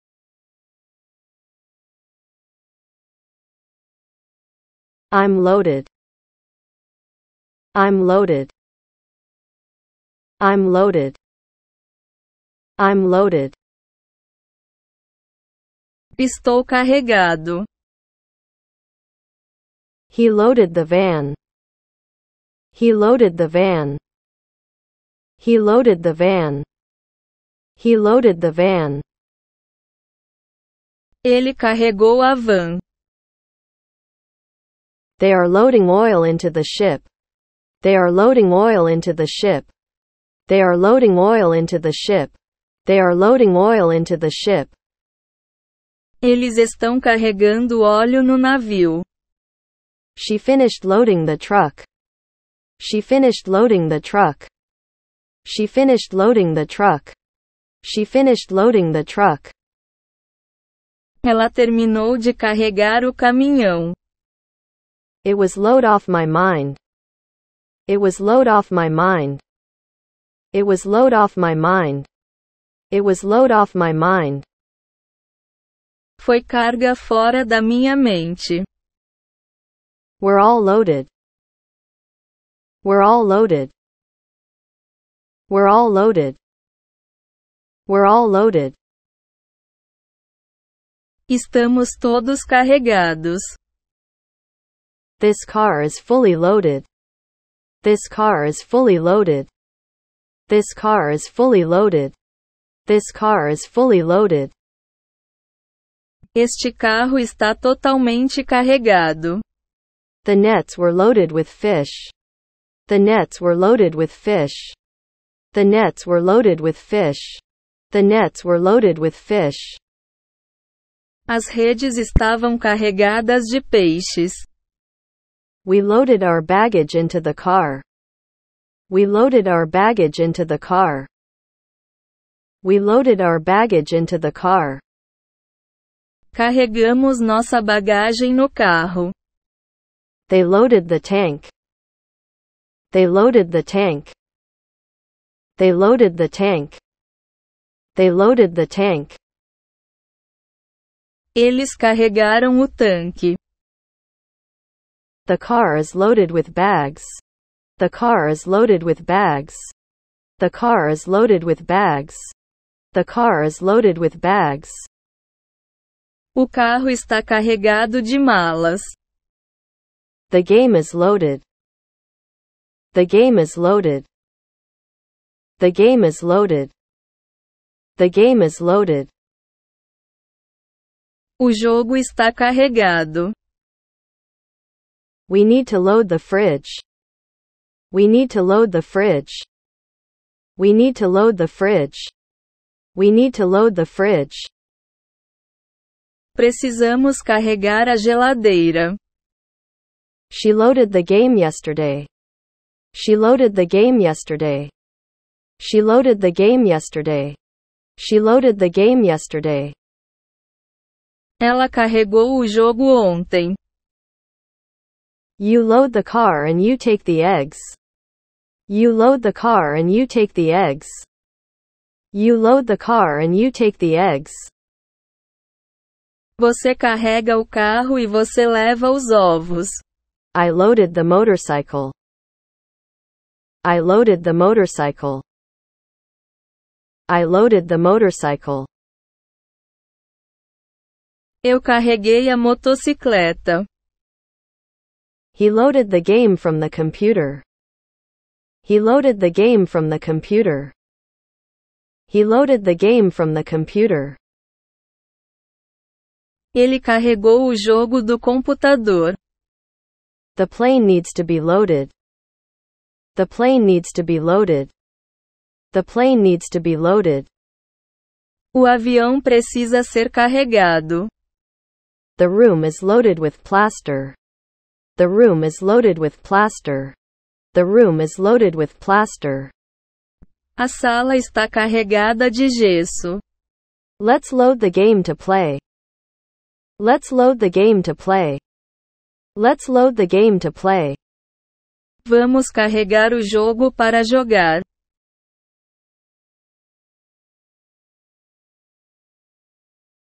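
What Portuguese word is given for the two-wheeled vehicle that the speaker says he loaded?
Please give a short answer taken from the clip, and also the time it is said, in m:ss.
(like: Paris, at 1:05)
motocicleta, at 4:02.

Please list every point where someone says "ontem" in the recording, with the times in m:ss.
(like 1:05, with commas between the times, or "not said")
3:33.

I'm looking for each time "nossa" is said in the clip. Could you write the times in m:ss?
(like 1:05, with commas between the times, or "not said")
2:17.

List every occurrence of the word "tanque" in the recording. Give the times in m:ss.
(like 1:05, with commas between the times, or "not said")
2:32.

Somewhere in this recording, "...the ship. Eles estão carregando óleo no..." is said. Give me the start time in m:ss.
0:44.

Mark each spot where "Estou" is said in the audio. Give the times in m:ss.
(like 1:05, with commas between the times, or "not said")
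0:16.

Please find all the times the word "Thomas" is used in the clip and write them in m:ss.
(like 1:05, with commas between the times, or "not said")
not said.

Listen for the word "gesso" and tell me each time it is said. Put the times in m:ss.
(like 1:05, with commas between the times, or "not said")
4:42.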